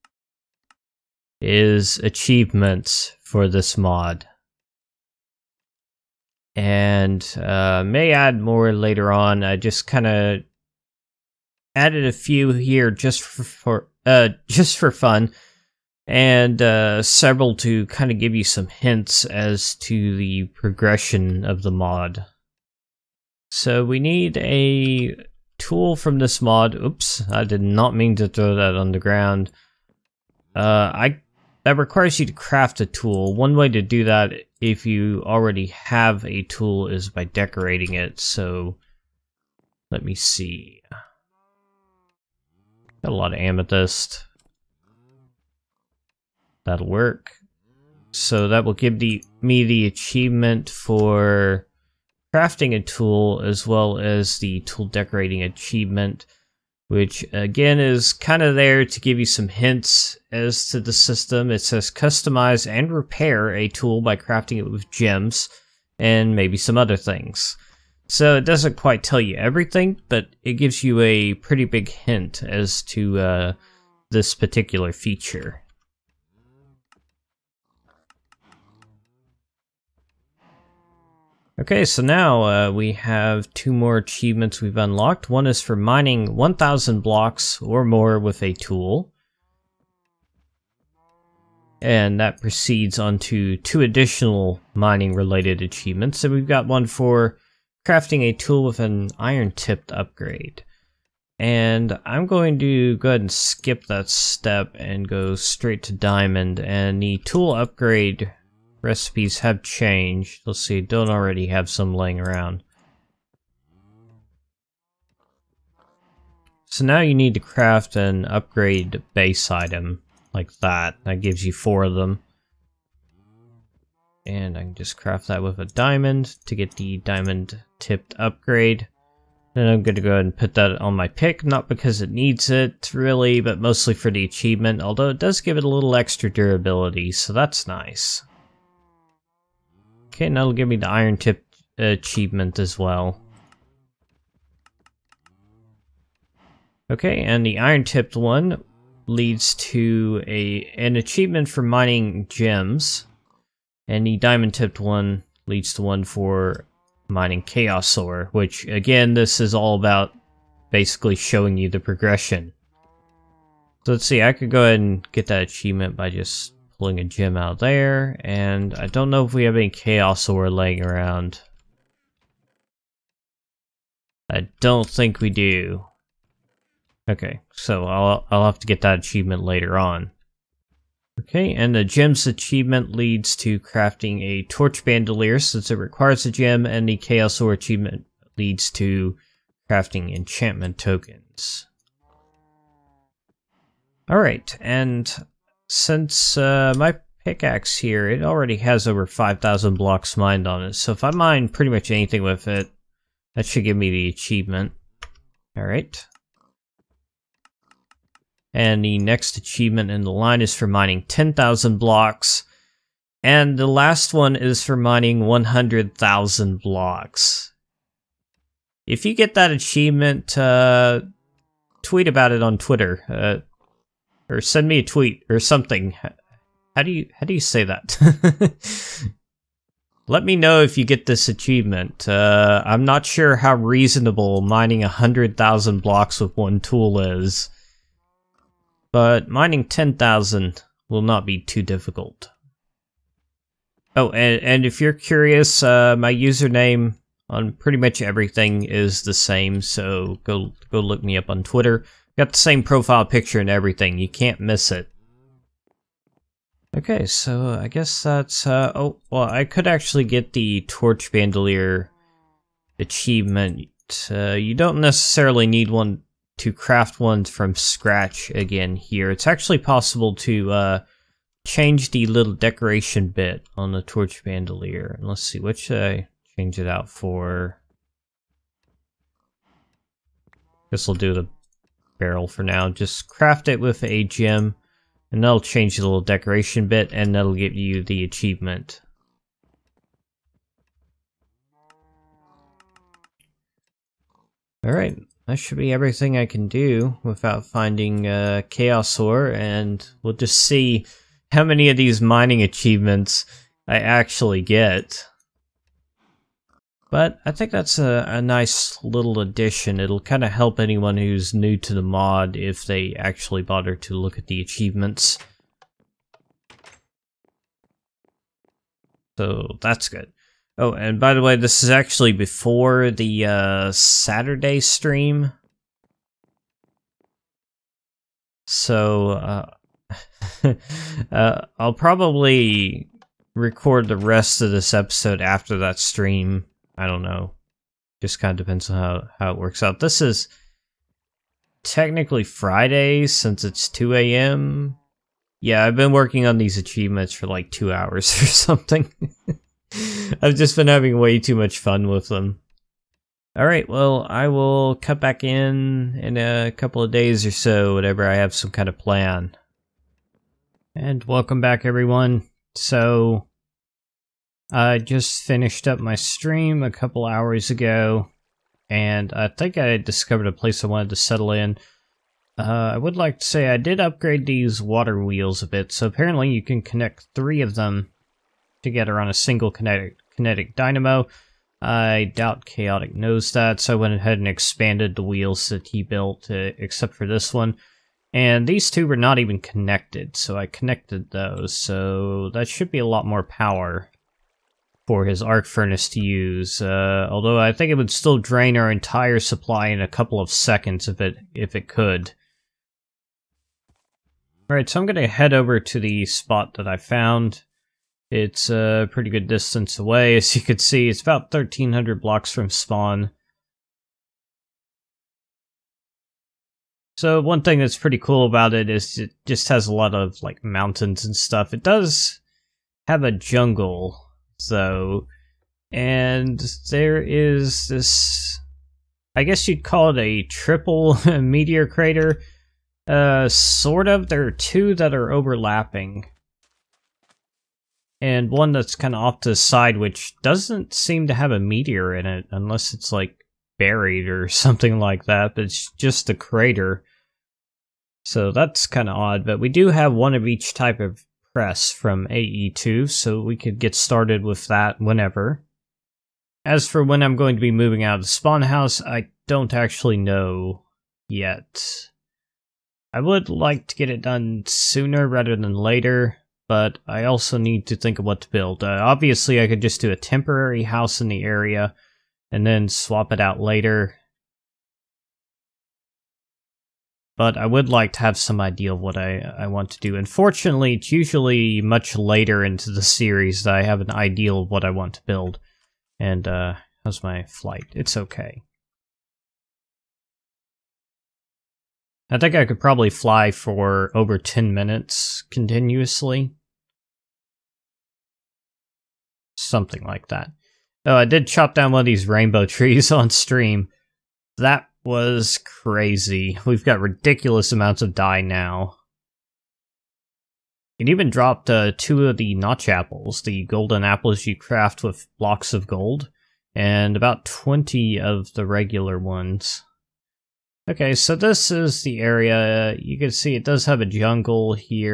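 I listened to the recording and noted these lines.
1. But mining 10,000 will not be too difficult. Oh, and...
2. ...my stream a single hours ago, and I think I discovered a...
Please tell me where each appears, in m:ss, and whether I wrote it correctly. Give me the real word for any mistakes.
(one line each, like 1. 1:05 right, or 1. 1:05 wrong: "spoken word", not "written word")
1. 3:58 right
2. 6:05 wrong: "couple", not "single".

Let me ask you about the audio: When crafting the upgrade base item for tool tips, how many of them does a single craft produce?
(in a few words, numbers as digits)
4.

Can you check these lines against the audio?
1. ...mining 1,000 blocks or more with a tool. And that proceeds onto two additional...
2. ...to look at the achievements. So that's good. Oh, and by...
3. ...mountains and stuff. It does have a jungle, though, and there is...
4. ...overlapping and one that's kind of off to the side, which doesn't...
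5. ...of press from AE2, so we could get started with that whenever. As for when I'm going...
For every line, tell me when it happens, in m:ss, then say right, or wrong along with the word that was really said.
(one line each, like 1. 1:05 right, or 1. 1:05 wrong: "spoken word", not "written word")
1. 1:25 right
2. 5:13 right
3. 7:00 right
4. 7:15 right
5. 7:30 right.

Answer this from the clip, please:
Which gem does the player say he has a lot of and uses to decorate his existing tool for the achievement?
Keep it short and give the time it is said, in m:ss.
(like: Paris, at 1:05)
amethyst, at 0:43.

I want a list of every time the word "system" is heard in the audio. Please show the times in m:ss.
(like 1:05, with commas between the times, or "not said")
1:00.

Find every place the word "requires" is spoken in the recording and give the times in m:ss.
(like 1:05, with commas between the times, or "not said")
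0:31, 3:05.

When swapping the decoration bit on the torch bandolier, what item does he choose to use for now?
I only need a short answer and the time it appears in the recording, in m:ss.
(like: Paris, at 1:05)
barrel, at 4:41.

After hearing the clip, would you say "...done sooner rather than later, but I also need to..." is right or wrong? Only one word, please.
right.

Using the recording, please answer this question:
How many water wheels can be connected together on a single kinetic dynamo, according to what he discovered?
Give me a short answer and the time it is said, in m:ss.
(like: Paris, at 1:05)
3, at 6:17.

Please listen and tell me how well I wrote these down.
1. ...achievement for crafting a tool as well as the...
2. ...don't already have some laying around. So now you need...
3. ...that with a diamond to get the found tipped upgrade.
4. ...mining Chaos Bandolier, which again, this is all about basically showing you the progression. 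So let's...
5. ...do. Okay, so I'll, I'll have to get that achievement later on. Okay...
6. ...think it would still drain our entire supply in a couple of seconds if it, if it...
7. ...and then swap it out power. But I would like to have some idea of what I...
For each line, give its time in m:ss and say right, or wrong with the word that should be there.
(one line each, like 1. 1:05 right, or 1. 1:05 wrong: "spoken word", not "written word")
1. 0:49 right
2. 1:50 right
3. 2:05 wrong: "diamond", not "found"
4. 2:37 wrong: "Ore", not "Bandolier"
5. 2:55 right
6. 6:37 right
7. 7:52 wrong: "later", not "power".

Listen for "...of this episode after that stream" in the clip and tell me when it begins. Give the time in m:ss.
5:34.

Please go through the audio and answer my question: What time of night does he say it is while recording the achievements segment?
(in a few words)
2 a.m.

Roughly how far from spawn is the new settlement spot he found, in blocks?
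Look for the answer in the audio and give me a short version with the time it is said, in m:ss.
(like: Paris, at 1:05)
1,300, at 6:51.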